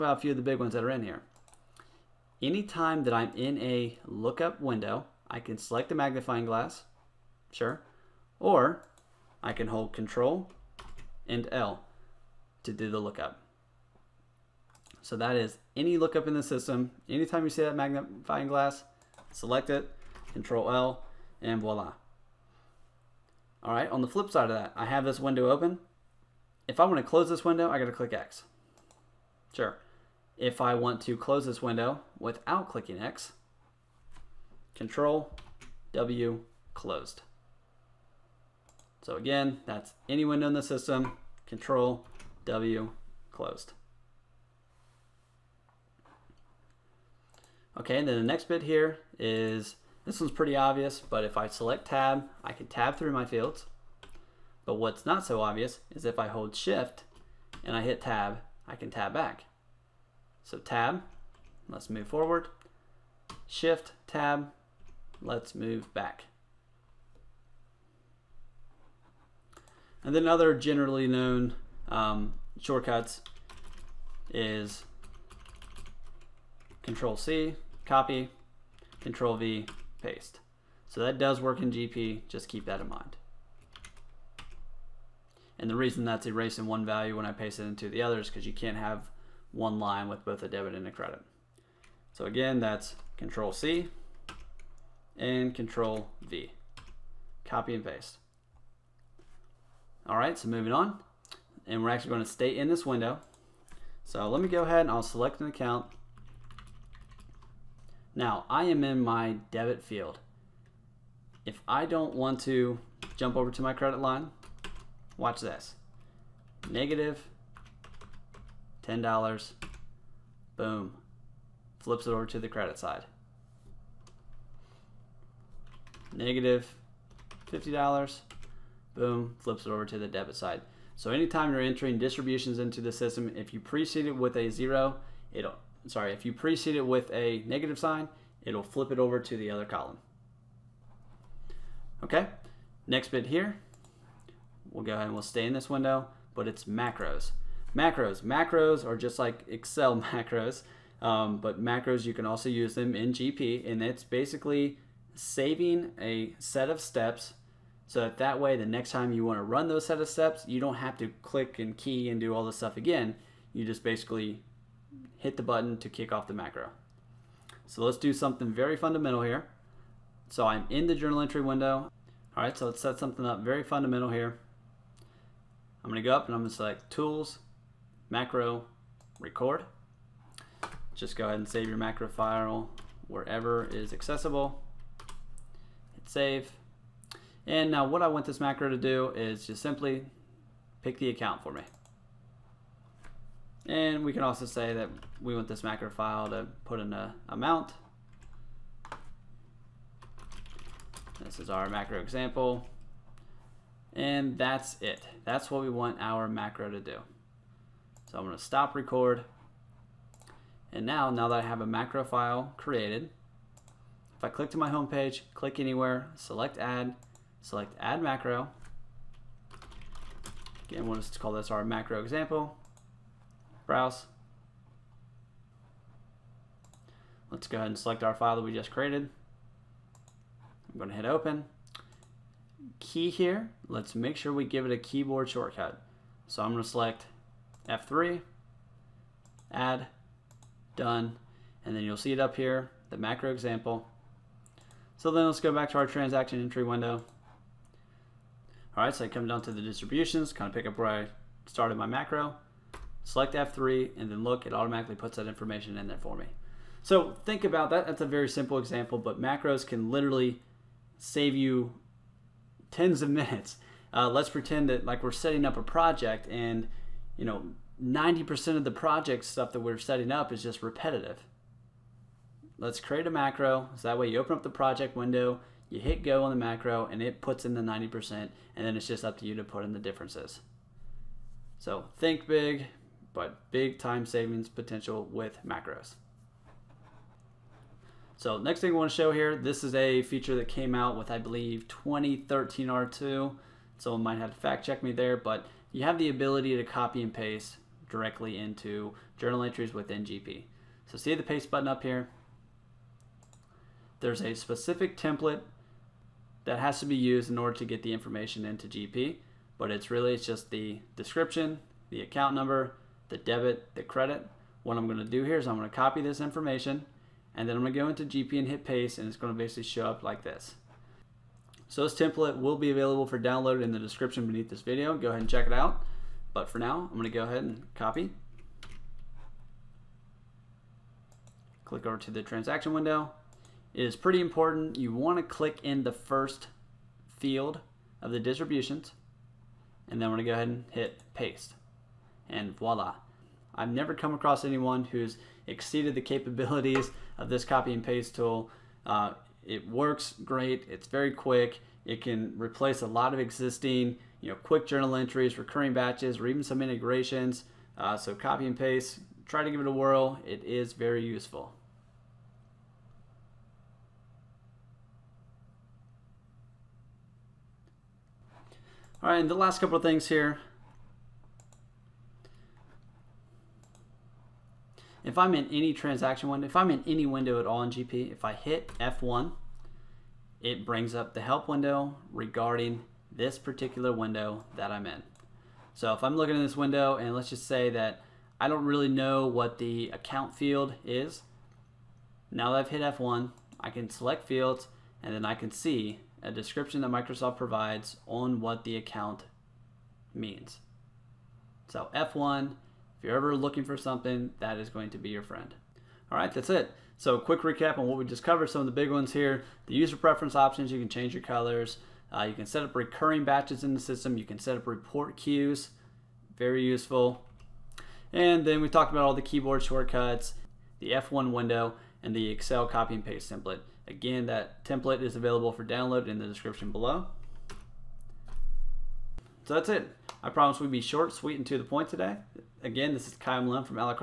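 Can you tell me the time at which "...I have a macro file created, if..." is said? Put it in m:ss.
3:31.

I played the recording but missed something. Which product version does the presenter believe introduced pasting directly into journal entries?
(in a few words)
2013 R2.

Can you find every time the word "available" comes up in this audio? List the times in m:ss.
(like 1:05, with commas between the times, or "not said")
5:22, 7:05.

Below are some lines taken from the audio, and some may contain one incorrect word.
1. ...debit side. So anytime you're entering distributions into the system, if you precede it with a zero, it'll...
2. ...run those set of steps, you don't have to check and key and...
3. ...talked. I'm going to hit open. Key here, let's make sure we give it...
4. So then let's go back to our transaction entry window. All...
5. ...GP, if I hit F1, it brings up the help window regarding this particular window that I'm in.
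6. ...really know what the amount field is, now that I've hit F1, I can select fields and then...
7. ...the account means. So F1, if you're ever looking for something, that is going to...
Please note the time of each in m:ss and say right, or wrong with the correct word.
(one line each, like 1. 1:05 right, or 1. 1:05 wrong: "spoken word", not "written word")
1. 2:10 right
2. 2:39 wrong: "click", not "check"
3. 3:48 wrong: "created", not "talked"
4. 4:04 right
5. 6:17 right
6. 6:28 wrong: "account", not "amount"
7. 6:38 right.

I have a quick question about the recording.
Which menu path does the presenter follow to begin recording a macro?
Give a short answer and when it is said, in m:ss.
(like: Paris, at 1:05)
Tools, Macro, Record, at 2:56.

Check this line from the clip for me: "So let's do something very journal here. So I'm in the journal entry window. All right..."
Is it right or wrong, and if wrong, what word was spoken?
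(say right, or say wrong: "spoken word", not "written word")
wrong: "fundamental", not "journal".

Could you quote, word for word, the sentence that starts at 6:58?
And then we talked about all the keyboard shortcuts, the F1 window, and the Excel copy and paste template.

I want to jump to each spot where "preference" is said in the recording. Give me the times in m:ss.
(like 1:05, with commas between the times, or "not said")
6:49.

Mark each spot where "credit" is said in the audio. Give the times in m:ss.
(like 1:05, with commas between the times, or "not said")
1:30, 1:53, 2:02, 5:13.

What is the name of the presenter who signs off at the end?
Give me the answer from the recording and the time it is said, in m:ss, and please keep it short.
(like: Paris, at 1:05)
Kyle Lynn, at 7:13.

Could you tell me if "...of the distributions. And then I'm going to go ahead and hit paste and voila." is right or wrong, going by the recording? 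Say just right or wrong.
right.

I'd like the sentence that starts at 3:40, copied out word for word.
Again, we'll just call this our macro example browse.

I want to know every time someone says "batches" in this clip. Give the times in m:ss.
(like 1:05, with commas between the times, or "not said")
5:55, 6:53.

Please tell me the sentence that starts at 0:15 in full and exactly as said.
So that is any lookup in the system.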